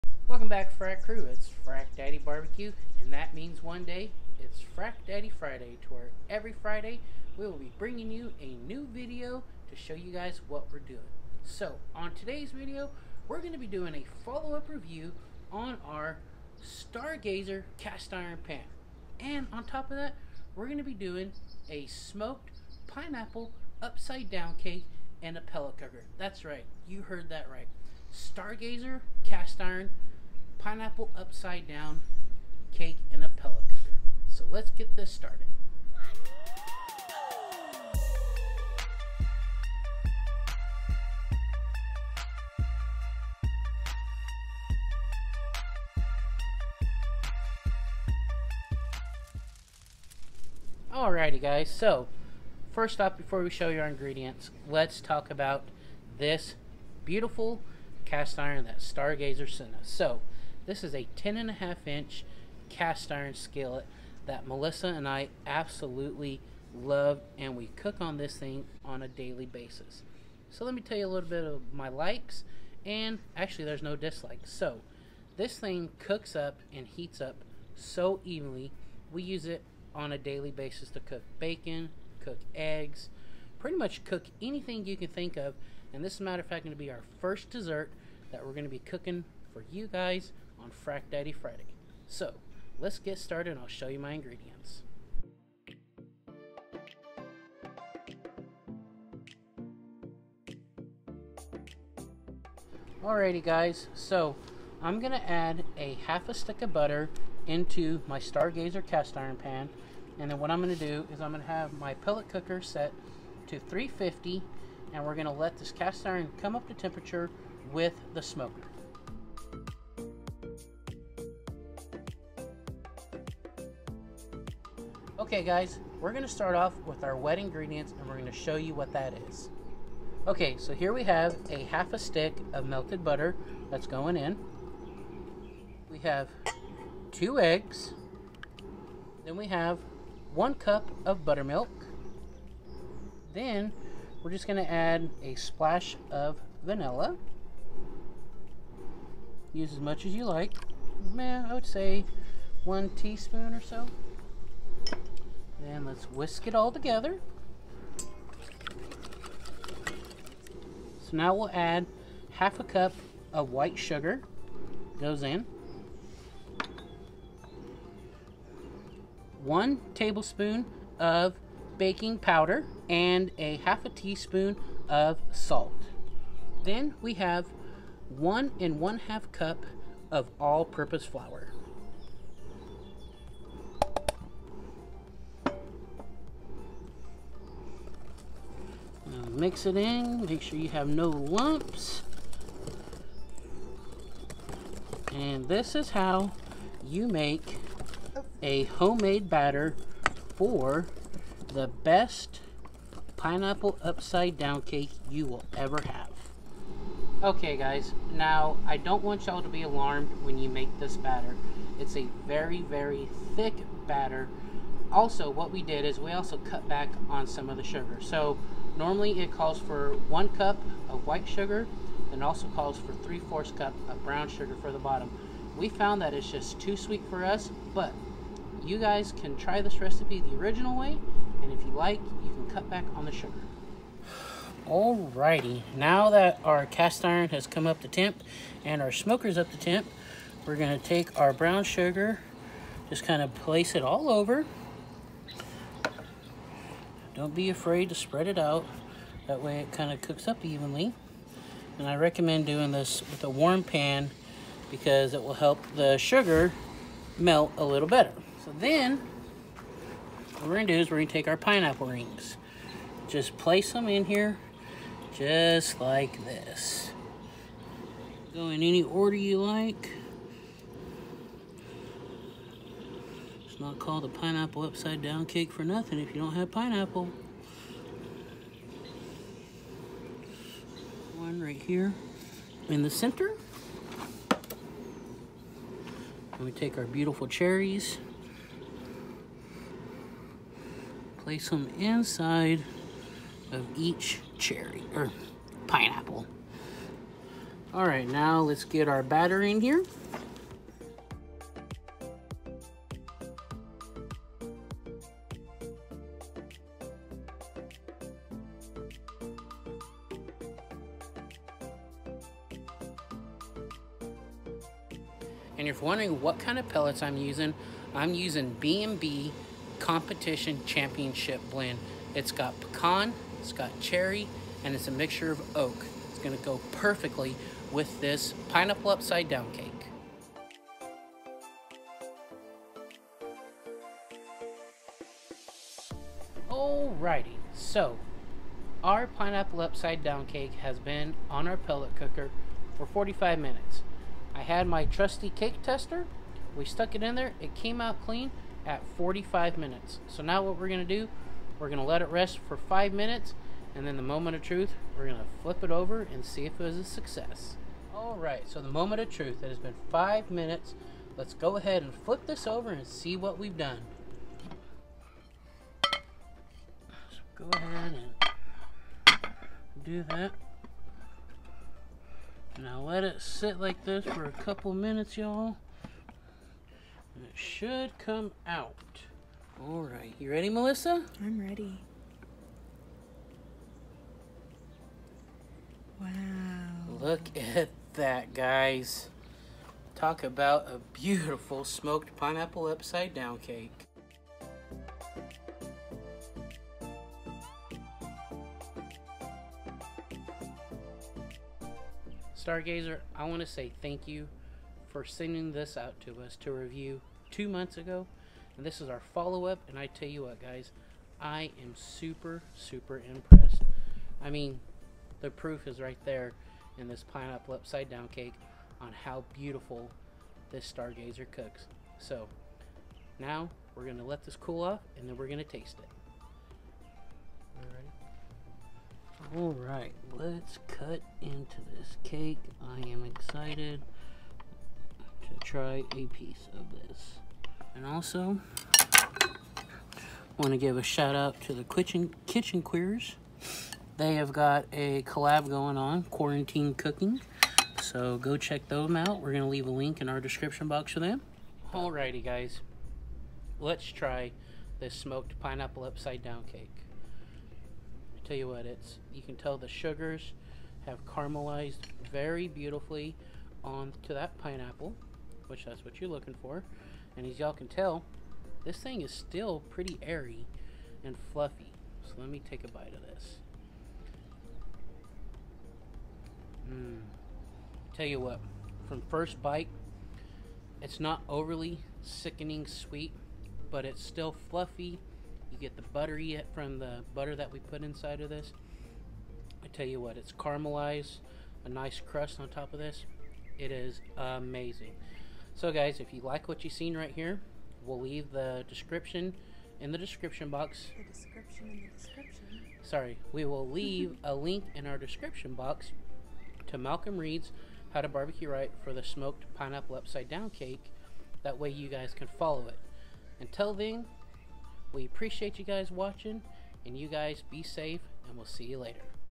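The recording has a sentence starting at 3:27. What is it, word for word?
Okay guys, now I don't want y'all to be alarmed when you make this batter.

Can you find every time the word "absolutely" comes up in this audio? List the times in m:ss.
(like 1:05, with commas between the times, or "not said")
1:05.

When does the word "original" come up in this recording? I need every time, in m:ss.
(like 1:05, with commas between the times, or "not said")
3:50.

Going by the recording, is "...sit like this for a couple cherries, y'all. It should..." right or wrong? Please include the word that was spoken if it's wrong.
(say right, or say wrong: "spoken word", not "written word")
wrong: "minutes", not "cherries".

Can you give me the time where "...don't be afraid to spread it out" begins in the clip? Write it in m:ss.
4:07.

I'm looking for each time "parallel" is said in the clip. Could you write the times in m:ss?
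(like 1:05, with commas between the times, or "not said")
not said.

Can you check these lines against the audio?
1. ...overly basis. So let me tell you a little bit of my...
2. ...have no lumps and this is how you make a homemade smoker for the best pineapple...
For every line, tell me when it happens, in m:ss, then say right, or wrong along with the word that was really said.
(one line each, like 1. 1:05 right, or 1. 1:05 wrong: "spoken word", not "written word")
1. 1:09 wrong: "daily", not "overly"
2. 3:10 wrong: "batter", not "smoker".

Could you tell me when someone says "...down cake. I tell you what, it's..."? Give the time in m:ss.
7:36.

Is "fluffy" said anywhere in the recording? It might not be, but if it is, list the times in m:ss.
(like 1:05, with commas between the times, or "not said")
7:51, 8:04.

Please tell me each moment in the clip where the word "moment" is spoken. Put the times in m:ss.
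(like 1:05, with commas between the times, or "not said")
5:54, 5:58.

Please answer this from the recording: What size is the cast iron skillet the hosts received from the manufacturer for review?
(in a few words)
10.5 inch.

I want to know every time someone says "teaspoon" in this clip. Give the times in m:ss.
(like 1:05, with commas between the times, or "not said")
2:32, 2:53.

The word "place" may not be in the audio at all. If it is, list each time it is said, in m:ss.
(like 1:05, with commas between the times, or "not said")
4:03, 4:23, 4:51.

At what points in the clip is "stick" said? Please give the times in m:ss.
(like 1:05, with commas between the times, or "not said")
1:46, 2:11.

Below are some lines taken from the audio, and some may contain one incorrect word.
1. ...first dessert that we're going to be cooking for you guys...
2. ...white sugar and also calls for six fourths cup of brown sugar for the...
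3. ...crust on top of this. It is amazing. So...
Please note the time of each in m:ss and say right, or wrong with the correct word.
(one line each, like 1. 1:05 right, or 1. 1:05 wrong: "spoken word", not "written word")
1. 1:27 right
2. 3:41 wrong: "three", not "six"
3. 8:12 right.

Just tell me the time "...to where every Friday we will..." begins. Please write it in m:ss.
0:05.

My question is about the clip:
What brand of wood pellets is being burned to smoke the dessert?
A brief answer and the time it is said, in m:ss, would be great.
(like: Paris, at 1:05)
B&B, at 5:18.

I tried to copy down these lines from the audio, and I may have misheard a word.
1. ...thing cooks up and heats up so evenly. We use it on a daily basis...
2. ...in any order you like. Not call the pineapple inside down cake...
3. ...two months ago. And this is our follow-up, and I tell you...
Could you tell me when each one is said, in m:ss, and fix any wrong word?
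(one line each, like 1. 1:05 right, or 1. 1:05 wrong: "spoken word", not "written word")
1. 1:15 right
2. 4:28 wrong: "upside", not "inside"
3. 6:47 right.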